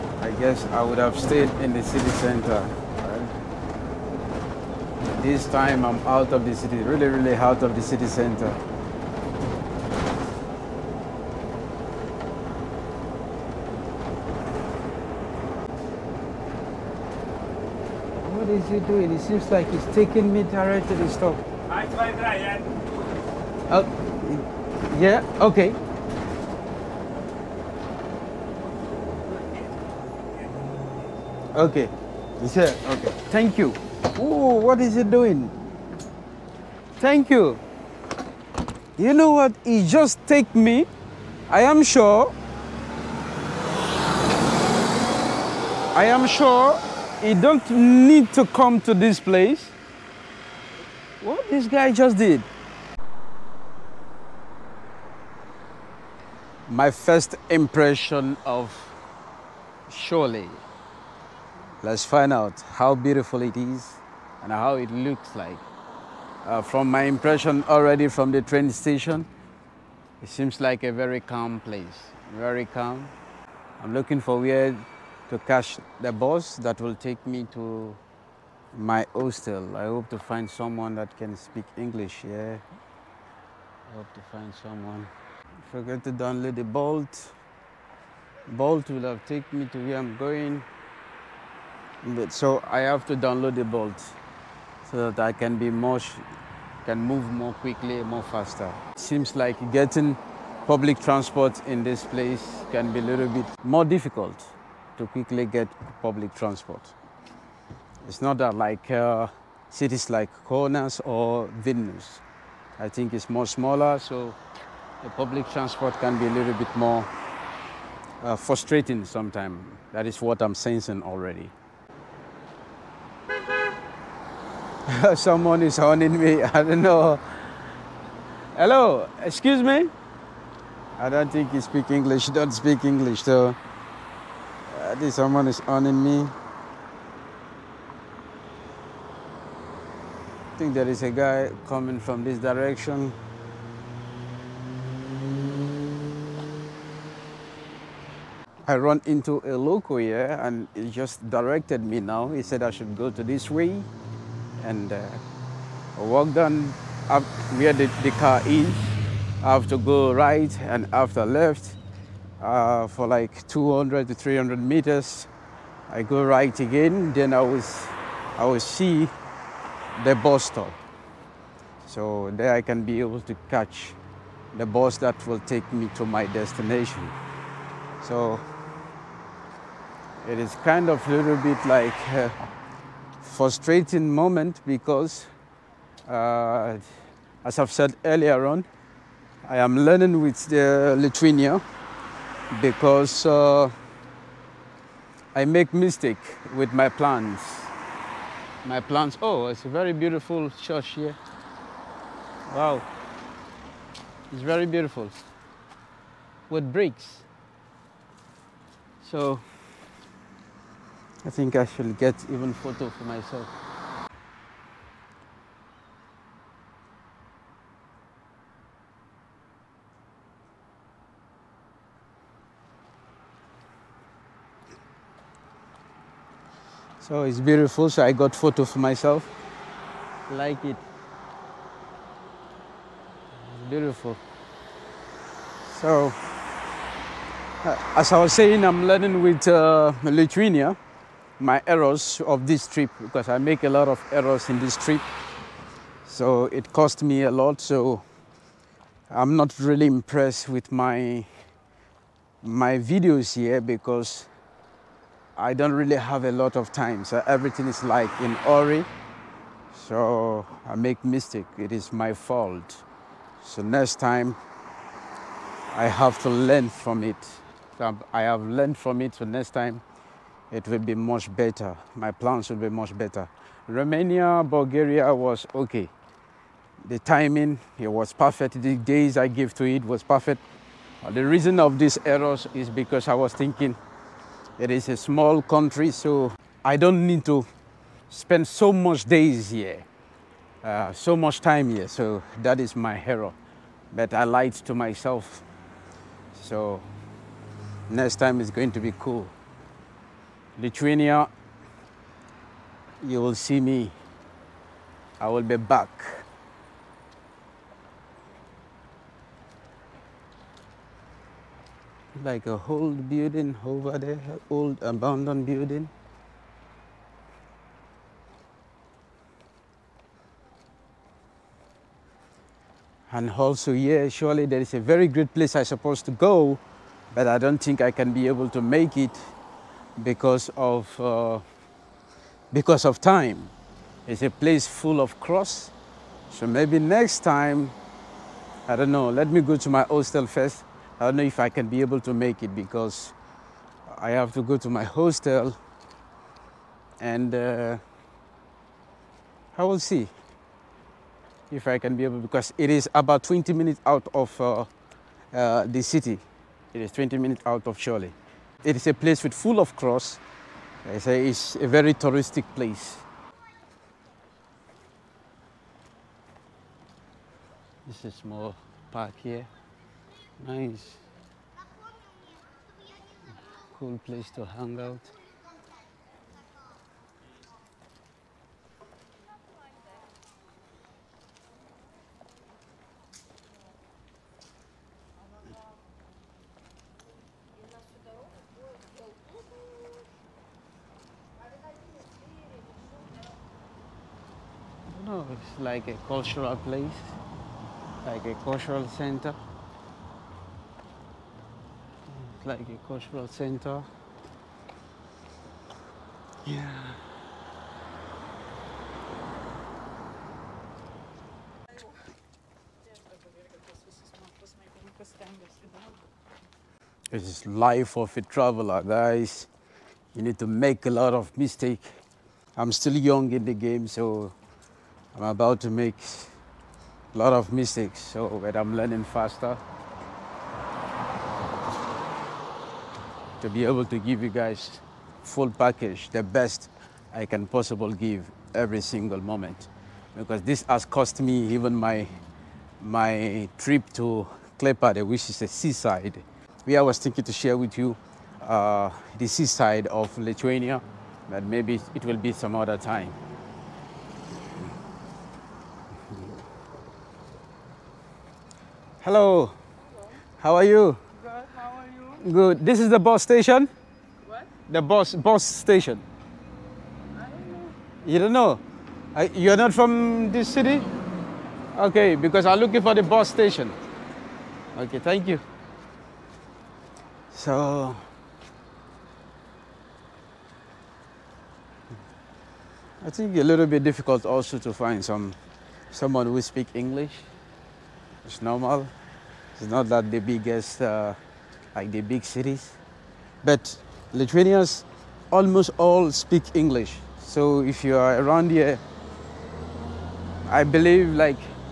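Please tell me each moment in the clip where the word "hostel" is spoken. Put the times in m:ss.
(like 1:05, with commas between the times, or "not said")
1:19, 5:39, 5:44.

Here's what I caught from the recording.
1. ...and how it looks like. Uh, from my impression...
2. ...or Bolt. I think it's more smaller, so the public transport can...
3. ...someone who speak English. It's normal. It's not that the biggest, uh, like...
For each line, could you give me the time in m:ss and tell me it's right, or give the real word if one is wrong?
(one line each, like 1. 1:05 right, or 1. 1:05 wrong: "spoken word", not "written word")
1. 1:04 right
2. 1:51 wrong: "Vilnius", not "Bolt"
3. 8:05 right.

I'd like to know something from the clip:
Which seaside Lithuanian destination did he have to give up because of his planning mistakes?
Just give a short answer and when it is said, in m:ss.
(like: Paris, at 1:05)
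Klaipėda, at 7:24.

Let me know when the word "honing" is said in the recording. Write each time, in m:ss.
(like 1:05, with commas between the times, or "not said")
2:05, 2:15.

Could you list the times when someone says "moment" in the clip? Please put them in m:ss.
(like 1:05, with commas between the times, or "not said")
3:04, 7:19.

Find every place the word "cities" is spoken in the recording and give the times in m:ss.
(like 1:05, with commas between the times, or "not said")
1:49, 8:12.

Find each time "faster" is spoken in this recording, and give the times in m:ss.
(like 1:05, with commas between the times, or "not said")
1:38, 7:09.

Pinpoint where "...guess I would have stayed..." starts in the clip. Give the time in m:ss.
0:00.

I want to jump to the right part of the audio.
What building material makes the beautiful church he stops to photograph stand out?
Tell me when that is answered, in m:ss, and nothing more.
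3:26.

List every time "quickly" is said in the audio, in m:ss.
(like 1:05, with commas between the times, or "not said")
1:37, 1:45.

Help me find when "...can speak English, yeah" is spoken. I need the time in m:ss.
1:21.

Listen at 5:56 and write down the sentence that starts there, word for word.
It is 20 minutes out of Šiauliai.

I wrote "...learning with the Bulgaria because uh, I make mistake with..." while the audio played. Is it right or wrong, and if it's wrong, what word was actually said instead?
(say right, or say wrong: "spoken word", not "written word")
wrong: "Lithuania", not "Bulgaria".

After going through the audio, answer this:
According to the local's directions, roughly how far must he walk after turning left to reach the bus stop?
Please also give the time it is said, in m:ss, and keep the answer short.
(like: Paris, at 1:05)
200 to 300 meters, at 2:43.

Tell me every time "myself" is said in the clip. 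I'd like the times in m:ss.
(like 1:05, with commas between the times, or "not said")
3:33, 3:48, 4:54.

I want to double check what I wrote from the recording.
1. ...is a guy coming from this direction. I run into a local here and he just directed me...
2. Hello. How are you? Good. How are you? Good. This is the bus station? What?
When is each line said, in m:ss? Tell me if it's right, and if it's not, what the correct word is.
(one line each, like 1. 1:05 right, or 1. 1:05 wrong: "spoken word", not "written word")
1. 2:20 right
2. 7:39 right.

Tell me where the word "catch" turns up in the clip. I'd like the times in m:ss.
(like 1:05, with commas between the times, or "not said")
1:15, 2:53.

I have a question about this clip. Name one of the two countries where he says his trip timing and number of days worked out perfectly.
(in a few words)
Romania.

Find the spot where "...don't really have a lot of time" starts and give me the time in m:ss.
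4:15.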